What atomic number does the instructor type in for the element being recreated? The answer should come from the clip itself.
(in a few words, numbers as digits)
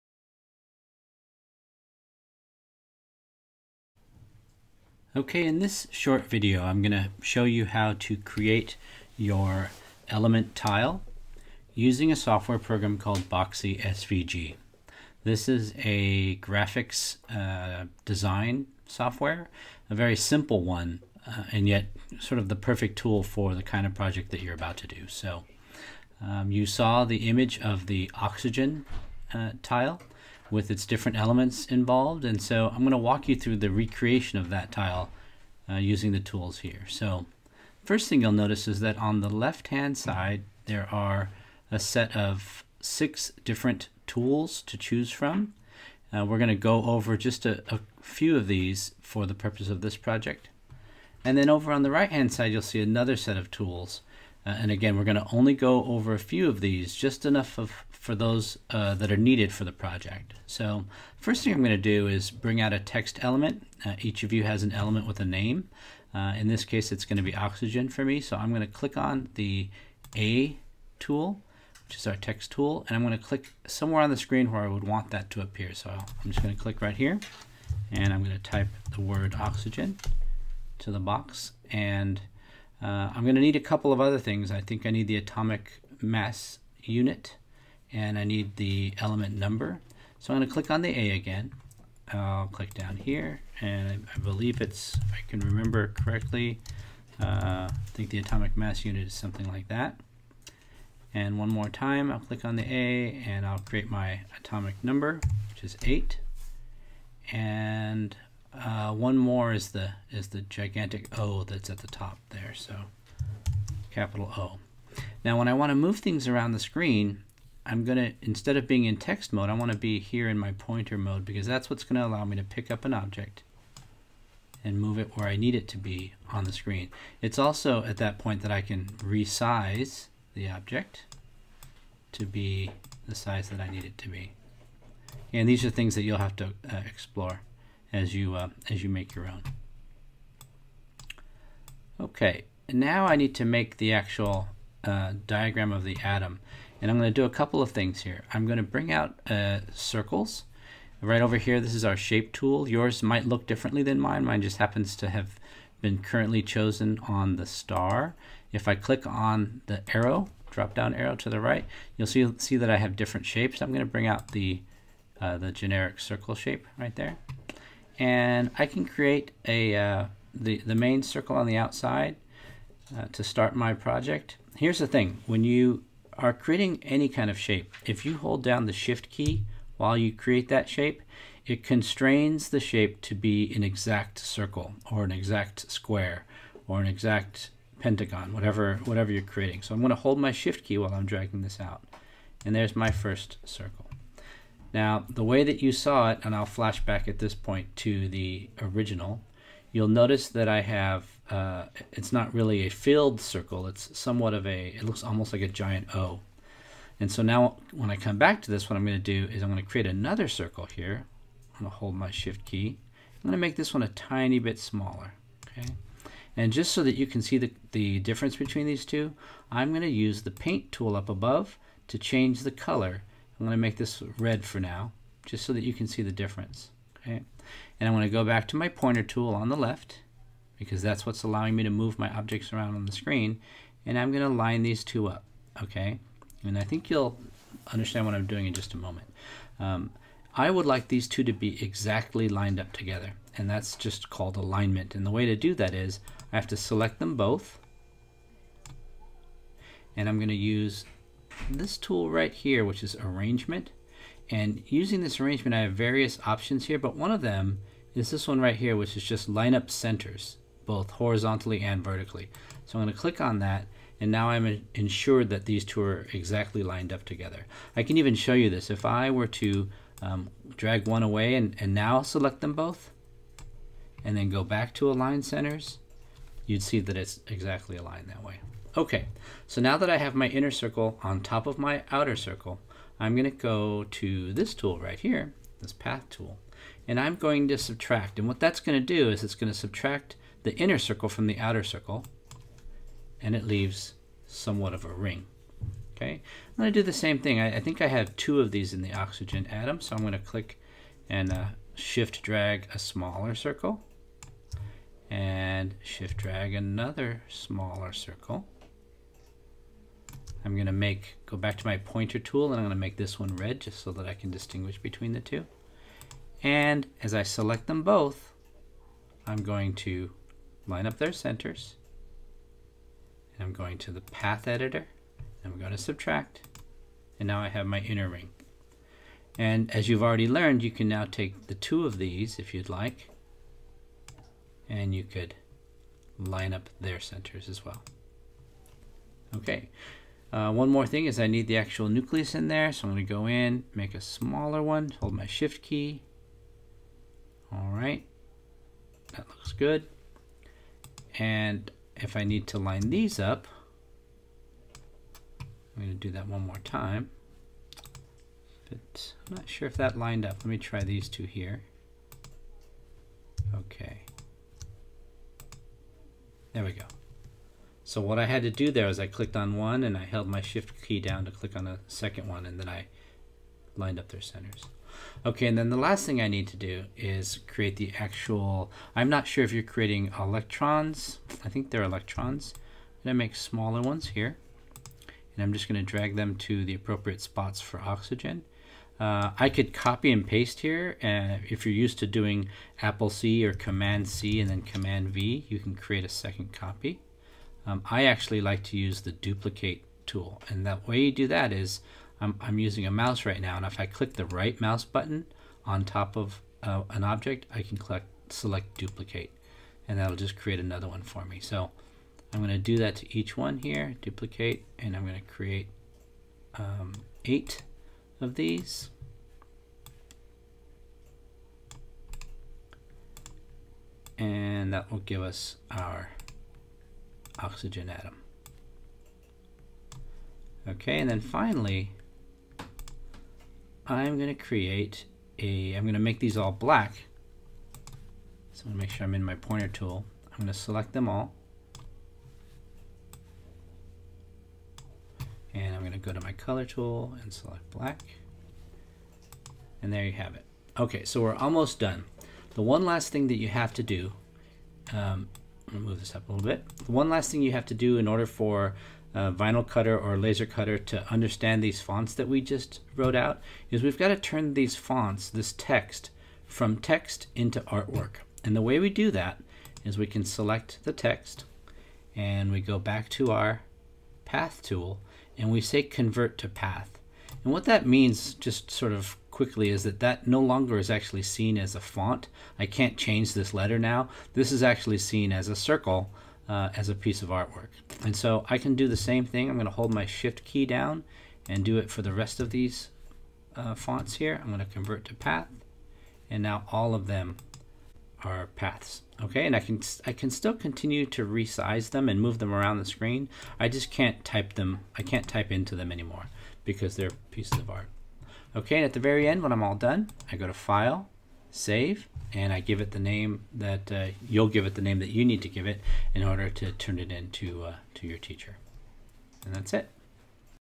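8.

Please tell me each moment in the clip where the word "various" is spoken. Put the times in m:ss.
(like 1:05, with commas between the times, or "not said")
4:15.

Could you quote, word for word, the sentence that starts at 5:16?
And as I select them both, I'm going to line up their centers.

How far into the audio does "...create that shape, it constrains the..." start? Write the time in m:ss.
3:00.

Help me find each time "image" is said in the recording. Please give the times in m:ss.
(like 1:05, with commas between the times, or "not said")
0:27.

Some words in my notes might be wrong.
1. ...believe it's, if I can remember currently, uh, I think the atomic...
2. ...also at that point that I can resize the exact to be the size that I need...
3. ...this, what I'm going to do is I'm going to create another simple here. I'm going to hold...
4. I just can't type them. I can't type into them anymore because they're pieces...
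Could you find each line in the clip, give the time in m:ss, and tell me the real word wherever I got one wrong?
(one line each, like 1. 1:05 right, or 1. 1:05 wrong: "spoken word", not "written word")
1. 1:34 wrong: "correctly", not "currently"
2. 2:07 wrong: "object", not "exact"
3. 3:28 wrong: "circle", not "simple"
4. 8:23 right.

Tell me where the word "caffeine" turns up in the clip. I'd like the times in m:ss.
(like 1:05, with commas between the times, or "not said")
not said.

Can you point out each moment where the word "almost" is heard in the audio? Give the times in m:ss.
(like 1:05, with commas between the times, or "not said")
3:25, 7:31.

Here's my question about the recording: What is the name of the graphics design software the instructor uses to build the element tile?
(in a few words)
Boxy SVG.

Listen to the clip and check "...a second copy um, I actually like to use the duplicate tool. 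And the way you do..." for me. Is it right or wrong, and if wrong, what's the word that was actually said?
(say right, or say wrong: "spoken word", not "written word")
right.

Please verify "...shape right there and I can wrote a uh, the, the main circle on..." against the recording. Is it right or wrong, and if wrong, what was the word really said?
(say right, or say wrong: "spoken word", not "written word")
wrong: "create", not "wrote".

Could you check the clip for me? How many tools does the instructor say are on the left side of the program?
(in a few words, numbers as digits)
6.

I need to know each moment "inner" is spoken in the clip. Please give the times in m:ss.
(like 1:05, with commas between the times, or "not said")
4:40, 4:50, 5:27.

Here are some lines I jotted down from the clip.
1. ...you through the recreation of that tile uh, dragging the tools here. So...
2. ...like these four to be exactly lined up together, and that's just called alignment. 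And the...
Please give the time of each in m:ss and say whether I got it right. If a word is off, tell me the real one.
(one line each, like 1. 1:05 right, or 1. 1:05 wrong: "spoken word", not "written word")
1. 0:33 wrong: "using", not "dragging"
2. 4:00 wrong: "two", not "four".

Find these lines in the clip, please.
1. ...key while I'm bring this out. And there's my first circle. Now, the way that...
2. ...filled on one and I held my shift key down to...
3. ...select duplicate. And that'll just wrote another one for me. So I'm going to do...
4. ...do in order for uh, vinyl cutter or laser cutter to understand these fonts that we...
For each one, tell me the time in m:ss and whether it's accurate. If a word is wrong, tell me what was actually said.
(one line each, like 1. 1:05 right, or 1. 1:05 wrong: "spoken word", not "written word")
1. 3:10 wrong: "dragging", not "bring"
2. 6:09 wrong: "clicked", not "filled"
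3. 6:48 wrong: "create", not "wrote"
4. 7:37 right.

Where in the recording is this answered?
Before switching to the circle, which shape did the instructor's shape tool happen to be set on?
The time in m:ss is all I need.
2:37.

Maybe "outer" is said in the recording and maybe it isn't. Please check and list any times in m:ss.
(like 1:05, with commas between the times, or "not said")
4:41, 4:51.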